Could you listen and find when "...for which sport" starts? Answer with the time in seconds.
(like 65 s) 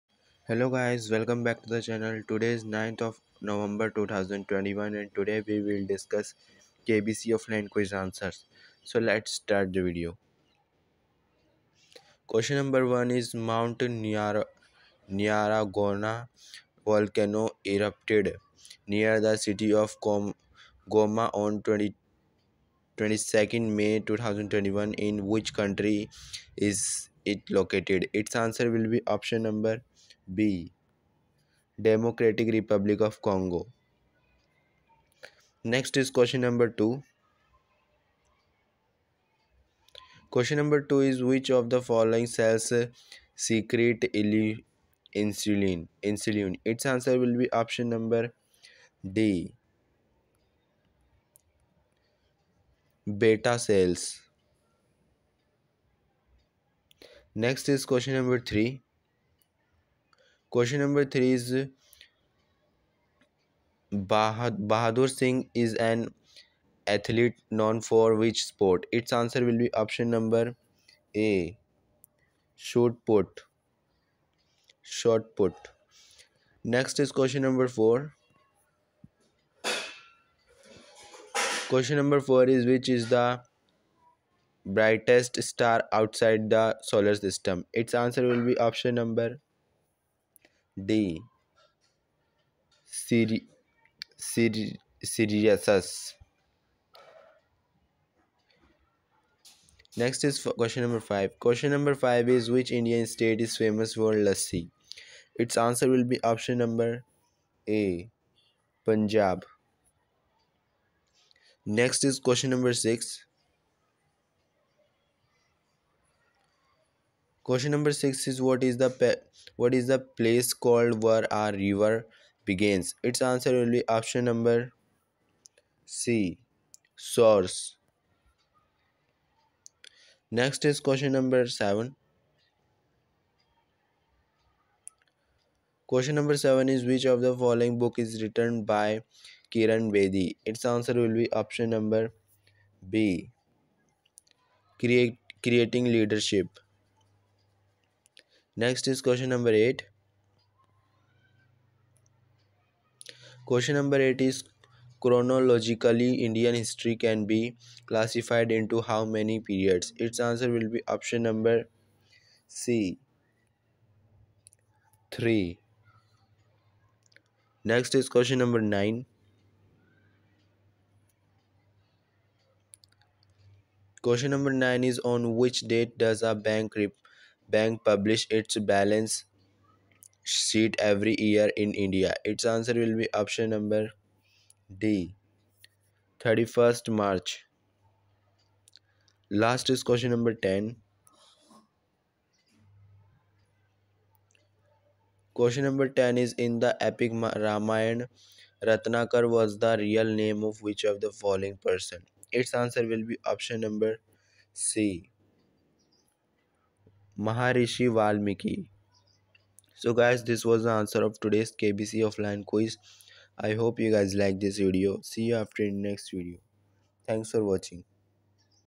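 67 s.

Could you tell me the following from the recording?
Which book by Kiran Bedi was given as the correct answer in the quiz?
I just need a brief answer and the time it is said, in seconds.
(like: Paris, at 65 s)
Creating Leadership, at 145 s.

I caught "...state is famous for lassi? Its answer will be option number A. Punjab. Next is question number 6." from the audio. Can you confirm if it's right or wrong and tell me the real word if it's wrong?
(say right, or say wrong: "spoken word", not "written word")
right.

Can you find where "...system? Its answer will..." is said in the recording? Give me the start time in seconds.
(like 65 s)
87 s.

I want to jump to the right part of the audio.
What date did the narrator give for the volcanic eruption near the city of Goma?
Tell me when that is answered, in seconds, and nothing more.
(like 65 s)
22 s.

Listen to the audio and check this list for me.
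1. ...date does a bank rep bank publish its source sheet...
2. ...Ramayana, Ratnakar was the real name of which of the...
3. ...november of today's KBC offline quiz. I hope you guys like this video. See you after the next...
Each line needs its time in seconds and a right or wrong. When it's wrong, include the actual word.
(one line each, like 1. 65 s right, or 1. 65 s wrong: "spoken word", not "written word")
1. 175 s wrong: "balance", not "source"
2. 197 s right
3. 210 s wrong: "answer", not "november".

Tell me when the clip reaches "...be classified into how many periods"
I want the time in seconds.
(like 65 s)
157 s.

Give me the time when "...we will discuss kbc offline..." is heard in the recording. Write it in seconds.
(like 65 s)
5 s.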